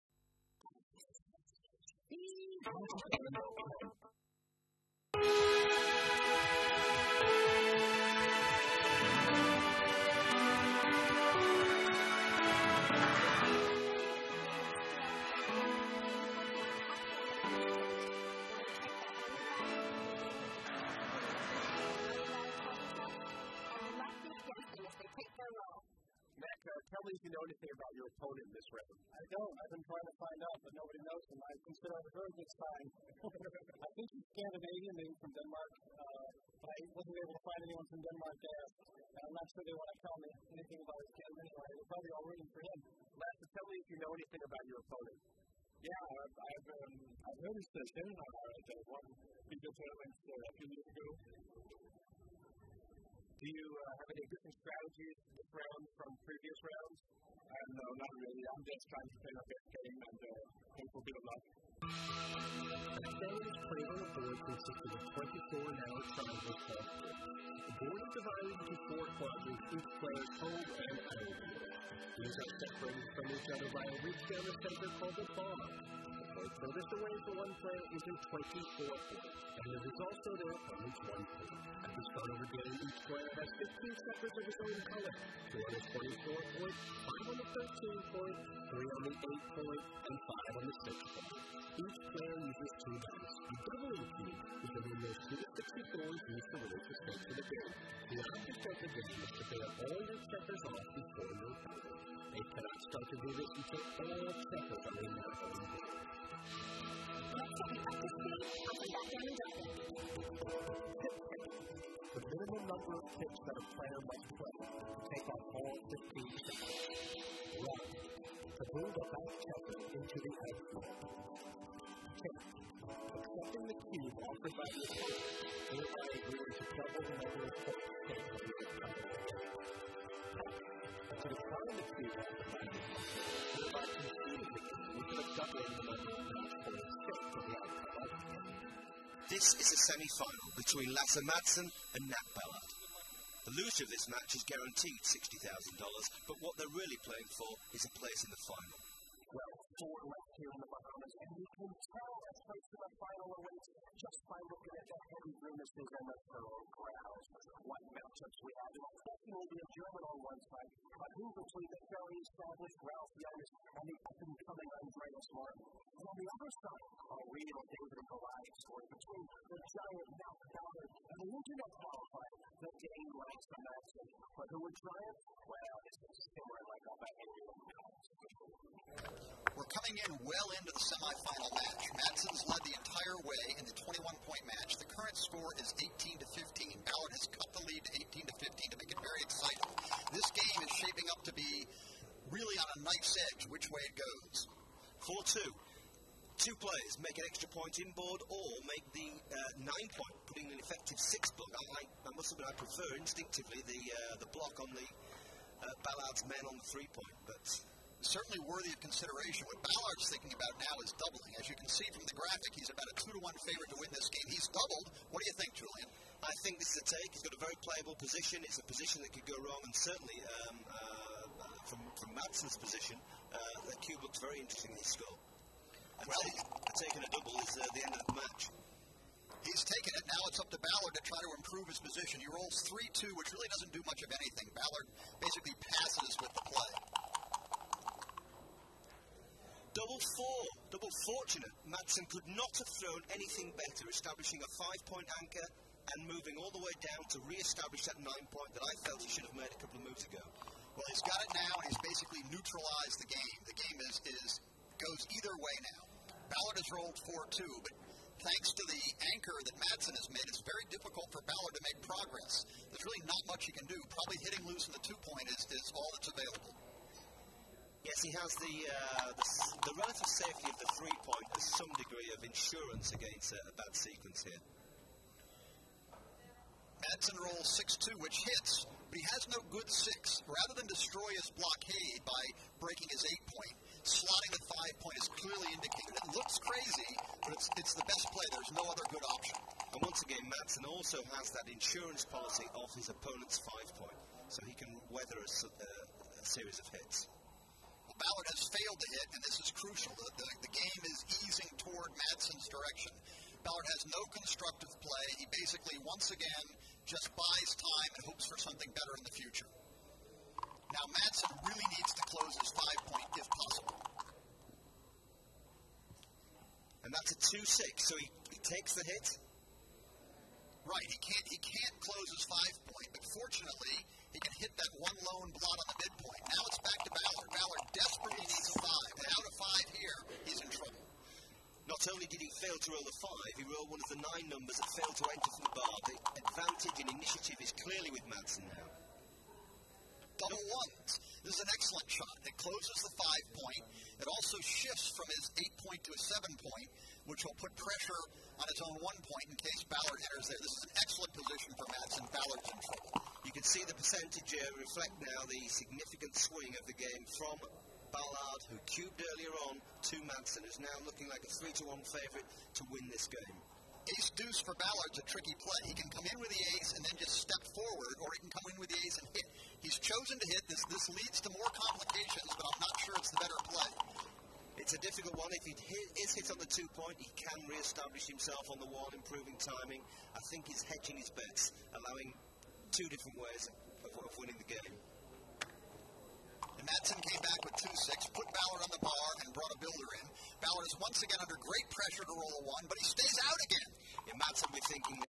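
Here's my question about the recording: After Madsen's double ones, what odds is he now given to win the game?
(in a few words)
3 to 1.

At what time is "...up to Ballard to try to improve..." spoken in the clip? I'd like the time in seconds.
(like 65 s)
230 s.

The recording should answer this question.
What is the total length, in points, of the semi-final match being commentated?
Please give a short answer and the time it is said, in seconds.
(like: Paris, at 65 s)
21, at 183 s.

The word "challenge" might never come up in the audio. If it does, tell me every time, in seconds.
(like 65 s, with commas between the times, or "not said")
not said.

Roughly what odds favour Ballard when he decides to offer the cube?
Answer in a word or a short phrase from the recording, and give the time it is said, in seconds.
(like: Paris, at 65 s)
2 to 1, at 212 s.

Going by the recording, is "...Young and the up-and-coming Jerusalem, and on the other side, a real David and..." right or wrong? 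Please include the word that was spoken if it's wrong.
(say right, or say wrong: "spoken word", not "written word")
right.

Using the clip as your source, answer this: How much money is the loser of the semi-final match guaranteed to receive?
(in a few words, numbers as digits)
$60,000.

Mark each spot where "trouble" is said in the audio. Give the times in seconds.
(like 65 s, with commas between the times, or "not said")
330 s, 352 s.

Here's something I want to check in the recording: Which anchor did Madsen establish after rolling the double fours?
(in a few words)
Five-point anchor.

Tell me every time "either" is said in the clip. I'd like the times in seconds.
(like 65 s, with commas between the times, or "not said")
255 s.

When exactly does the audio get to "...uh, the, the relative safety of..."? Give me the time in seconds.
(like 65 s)
268 s.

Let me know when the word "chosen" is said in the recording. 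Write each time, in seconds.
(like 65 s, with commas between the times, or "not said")
369 s.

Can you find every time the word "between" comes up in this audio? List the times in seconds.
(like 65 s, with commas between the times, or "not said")
140 s, 161 s, 168 s.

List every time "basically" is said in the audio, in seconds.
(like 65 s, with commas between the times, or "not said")
235 s, 251 s, 305 s.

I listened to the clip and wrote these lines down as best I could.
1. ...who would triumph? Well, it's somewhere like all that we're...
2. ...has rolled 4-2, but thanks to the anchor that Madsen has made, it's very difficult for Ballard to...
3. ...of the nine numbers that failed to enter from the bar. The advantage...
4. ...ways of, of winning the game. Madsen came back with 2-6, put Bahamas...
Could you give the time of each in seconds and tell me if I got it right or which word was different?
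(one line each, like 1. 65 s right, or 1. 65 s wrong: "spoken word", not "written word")
1. 174 s right
2. 256 s right
3. 333 s right
4. 383 s wrong: "Ballard", not "Bahamas".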